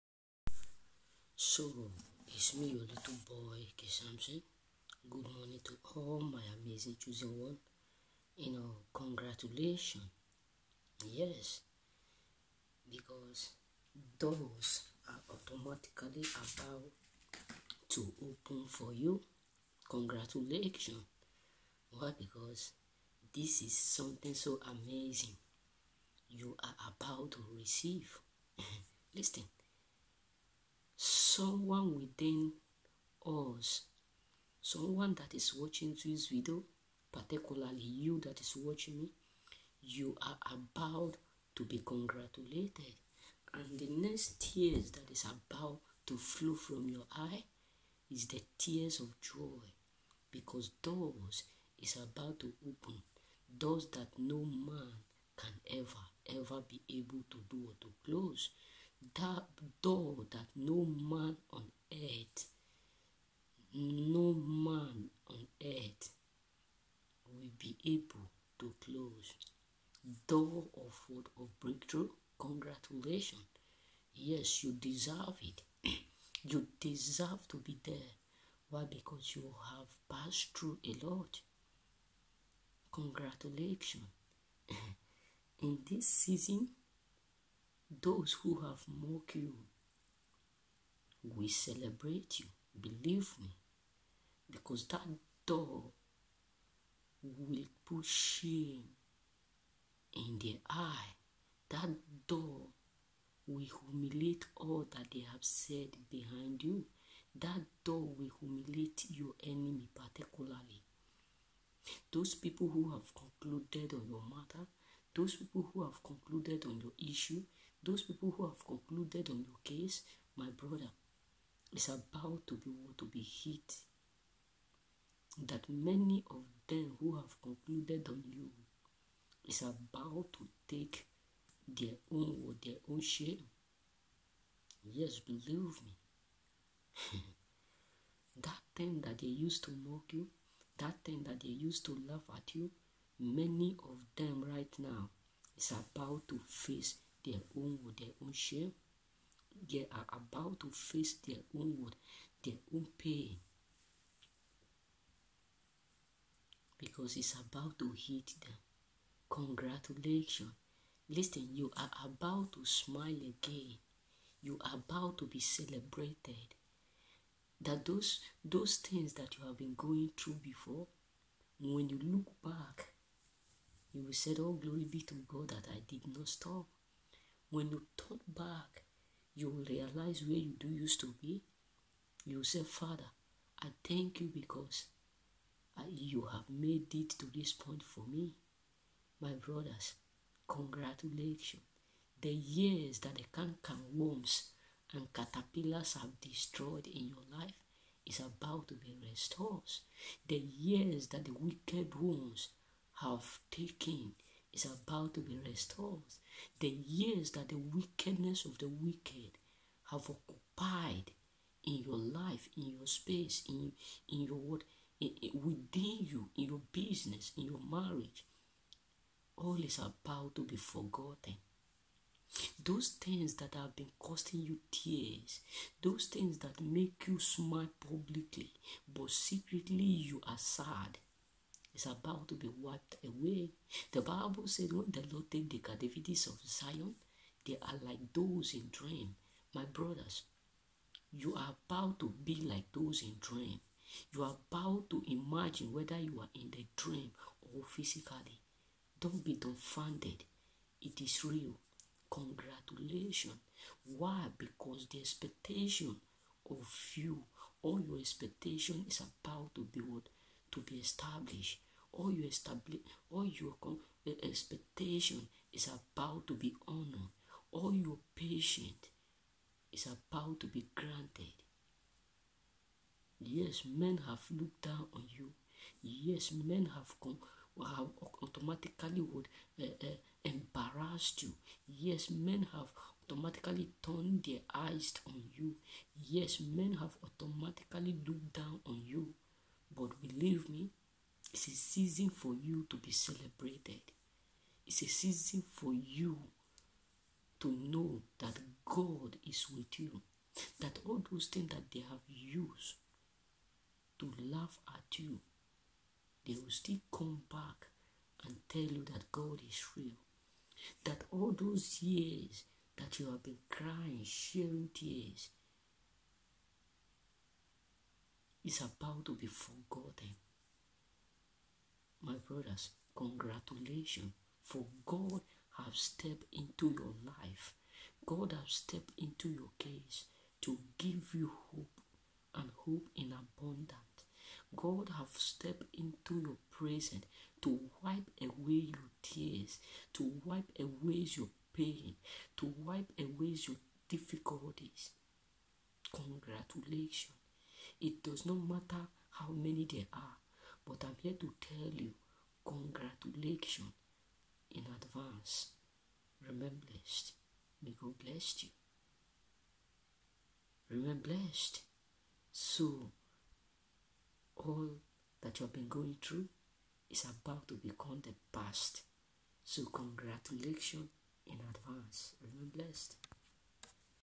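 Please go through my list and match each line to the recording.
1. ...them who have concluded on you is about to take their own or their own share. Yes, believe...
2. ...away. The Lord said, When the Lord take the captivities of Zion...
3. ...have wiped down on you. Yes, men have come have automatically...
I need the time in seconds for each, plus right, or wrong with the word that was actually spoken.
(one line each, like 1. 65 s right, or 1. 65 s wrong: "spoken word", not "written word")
1. 126 s right
2. 233 s wrong: "Bible", not "Lord"
3. 274 s wrong: "looked", not "wiped".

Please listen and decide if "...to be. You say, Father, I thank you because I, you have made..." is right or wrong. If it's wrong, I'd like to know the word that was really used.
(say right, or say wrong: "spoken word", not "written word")
right.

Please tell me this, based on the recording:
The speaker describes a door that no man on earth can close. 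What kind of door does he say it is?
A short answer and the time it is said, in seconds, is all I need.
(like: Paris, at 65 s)
breakthrough, at 71 s.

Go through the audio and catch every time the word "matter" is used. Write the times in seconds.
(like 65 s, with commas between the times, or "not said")
114 s, 348 s.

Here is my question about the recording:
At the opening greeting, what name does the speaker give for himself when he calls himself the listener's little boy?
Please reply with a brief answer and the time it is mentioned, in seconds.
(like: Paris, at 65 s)
K Samson, at 3 s.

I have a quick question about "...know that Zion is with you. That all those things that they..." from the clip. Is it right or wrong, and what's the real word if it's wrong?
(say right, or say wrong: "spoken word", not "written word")
wrong: "God", not "Zion".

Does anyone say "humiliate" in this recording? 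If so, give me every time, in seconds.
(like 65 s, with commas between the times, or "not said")
103 s, 108 s.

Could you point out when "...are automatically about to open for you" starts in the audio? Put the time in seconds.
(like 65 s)
15 s.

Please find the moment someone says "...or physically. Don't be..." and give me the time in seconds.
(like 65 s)
247 s.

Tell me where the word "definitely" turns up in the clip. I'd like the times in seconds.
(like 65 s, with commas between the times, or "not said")
not said.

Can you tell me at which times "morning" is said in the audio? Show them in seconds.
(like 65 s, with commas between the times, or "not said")
5 s.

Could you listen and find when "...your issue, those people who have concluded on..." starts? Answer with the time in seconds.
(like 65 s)
116 s.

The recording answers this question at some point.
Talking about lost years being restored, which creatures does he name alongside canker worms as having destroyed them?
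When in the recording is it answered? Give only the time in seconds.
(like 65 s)
195 s.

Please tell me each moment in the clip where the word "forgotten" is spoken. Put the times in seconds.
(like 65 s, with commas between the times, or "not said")
220 s, 319 s.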